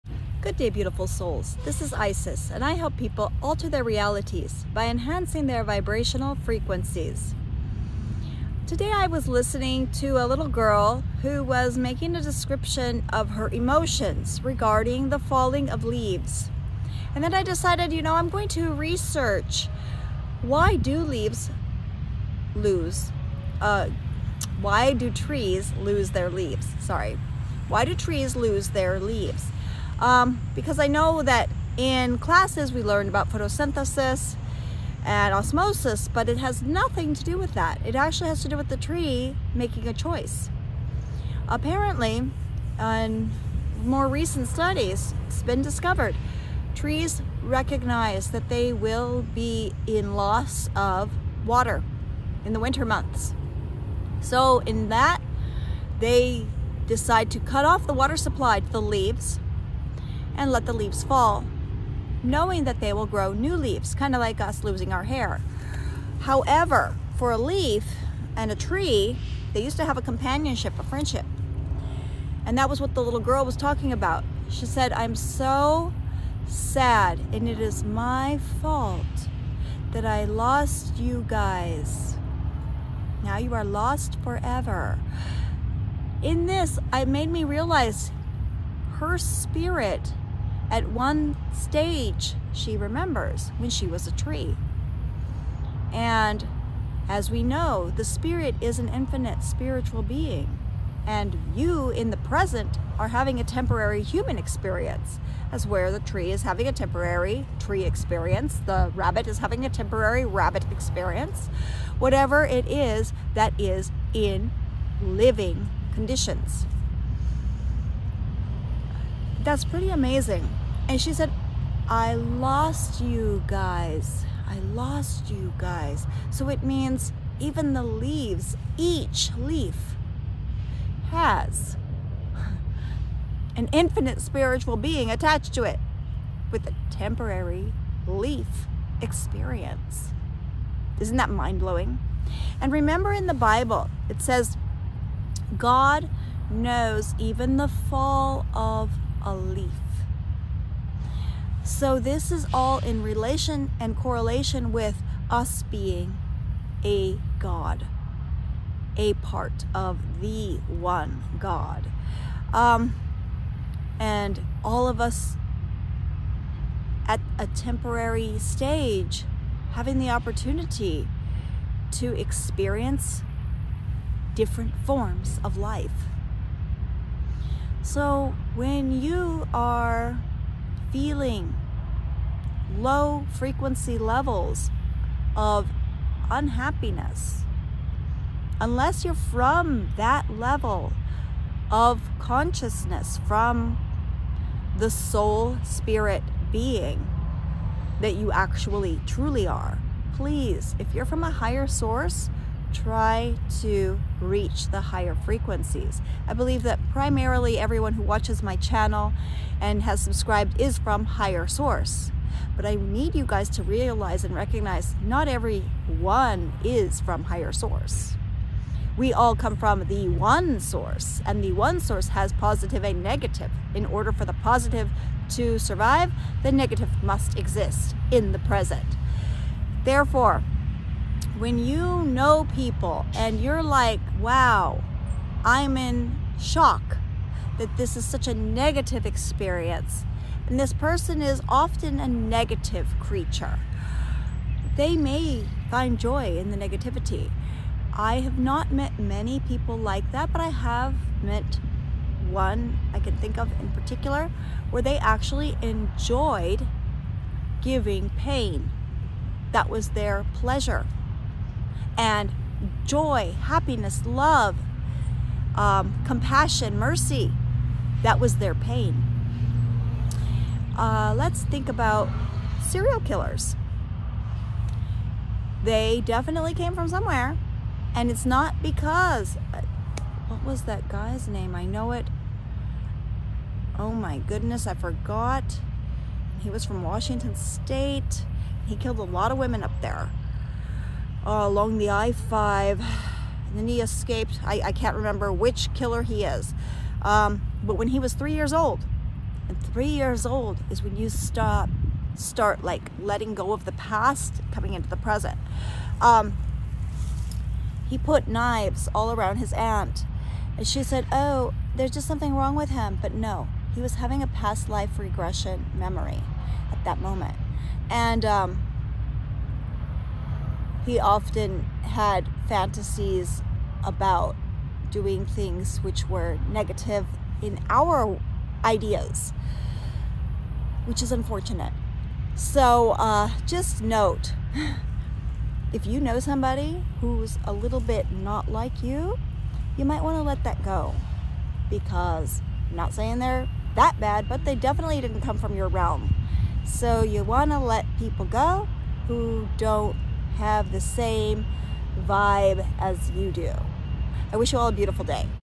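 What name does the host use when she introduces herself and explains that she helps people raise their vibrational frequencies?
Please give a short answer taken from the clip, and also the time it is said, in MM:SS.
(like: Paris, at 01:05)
Isis, at 00:01.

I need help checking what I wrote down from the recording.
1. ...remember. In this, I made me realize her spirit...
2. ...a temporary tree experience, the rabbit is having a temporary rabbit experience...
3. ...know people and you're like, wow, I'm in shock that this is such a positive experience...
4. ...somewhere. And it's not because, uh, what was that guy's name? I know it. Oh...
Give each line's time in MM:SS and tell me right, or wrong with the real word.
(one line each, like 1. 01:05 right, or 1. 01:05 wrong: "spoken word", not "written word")
1. 01:24 wrong: "forever", not "remember"
2. 01:46 right
3. 03:52 wrong: "negative", not "positive"
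4. 04:36 right.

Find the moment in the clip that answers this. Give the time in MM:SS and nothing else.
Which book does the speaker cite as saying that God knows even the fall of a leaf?
02:23.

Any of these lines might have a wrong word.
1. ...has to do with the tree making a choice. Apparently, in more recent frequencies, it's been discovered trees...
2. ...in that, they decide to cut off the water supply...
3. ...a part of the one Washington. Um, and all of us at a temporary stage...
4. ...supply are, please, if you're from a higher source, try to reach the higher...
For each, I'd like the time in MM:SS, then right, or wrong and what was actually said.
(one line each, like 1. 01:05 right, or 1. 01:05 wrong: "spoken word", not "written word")
1. 00:38 wrong: "studies", not "frequencies"
2. 00:54 right
3. 02:38 wrong: "God", not "Washington"
4. 03:19 wrong: "truly", not "supply".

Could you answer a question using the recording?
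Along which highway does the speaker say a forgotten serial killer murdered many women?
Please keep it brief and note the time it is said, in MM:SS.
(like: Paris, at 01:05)
I-5, at 04:51.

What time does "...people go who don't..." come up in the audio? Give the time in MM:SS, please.
05:47.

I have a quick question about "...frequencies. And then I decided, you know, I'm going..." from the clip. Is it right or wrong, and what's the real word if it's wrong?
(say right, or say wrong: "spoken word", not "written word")
wrong: "leaves", not "frequencies".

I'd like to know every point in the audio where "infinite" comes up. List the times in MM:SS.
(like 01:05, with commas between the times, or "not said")
01:38, 02:13.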